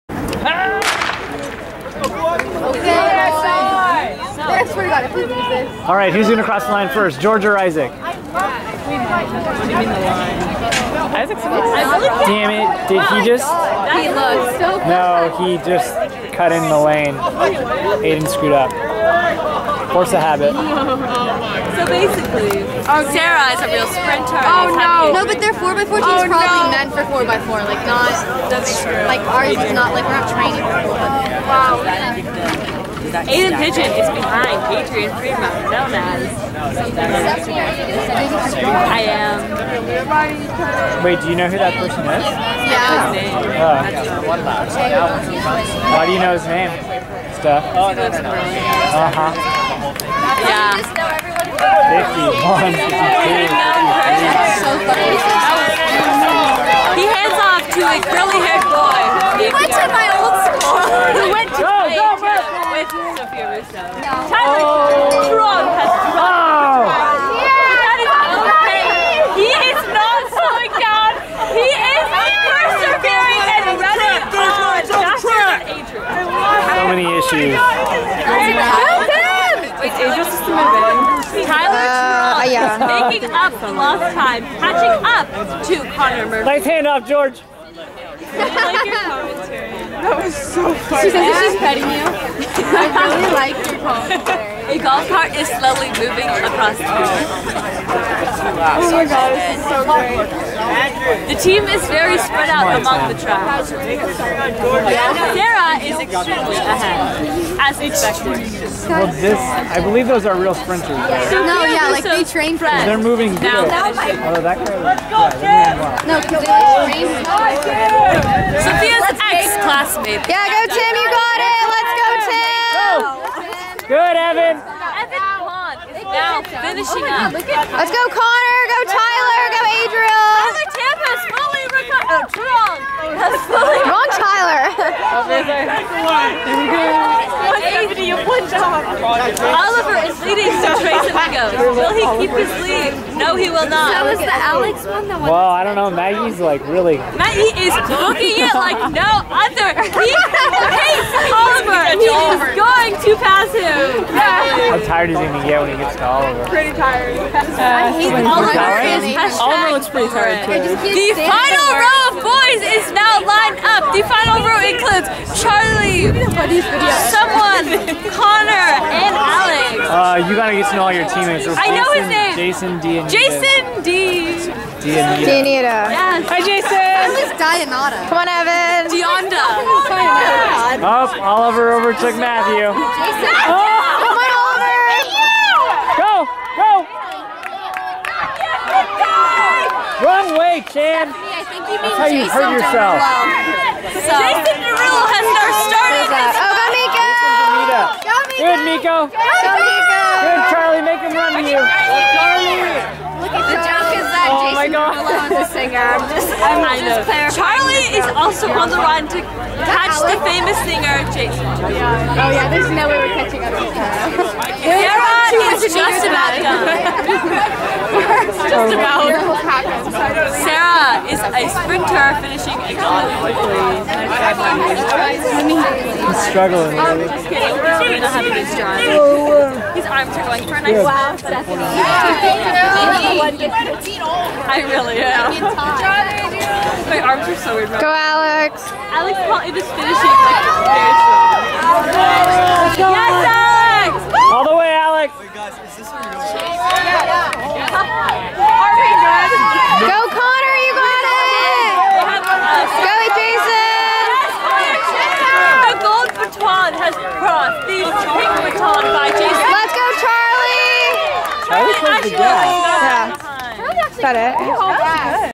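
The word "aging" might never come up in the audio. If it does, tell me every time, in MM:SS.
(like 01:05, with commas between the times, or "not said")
not said.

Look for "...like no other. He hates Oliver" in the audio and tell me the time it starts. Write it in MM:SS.
02:28.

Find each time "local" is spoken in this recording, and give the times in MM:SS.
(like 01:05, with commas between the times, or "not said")
not said.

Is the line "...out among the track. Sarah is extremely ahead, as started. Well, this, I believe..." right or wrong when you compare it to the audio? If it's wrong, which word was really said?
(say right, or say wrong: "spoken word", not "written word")
wrong: "expected", not "started".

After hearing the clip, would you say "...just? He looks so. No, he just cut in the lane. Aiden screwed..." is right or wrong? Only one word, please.
right.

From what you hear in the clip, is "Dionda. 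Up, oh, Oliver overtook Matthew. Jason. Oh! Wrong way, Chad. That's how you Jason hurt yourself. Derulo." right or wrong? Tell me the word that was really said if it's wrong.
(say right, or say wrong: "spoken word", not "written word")
right.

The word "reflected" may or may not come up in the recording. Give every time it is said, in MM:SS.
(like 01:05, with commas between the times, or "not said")
not said.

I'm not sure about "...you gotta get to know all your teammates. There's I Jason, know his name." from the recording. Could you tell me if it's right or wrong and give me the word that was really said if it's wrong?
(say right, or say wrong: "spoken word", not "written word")
right.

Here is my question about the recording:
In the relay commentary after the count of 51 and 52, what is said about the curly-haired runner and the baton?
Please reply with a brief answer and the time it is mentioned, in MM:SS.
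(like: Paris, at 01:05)
He hands off, at 00:51.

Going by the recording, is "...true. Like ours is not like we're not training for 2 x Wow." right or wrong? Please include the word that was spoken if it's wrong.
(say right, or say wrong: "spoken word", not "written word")
wrong: "4", not "2".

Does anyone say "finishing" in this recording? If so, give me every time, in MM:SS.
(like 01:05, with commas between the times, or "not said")
03:42, 03:59.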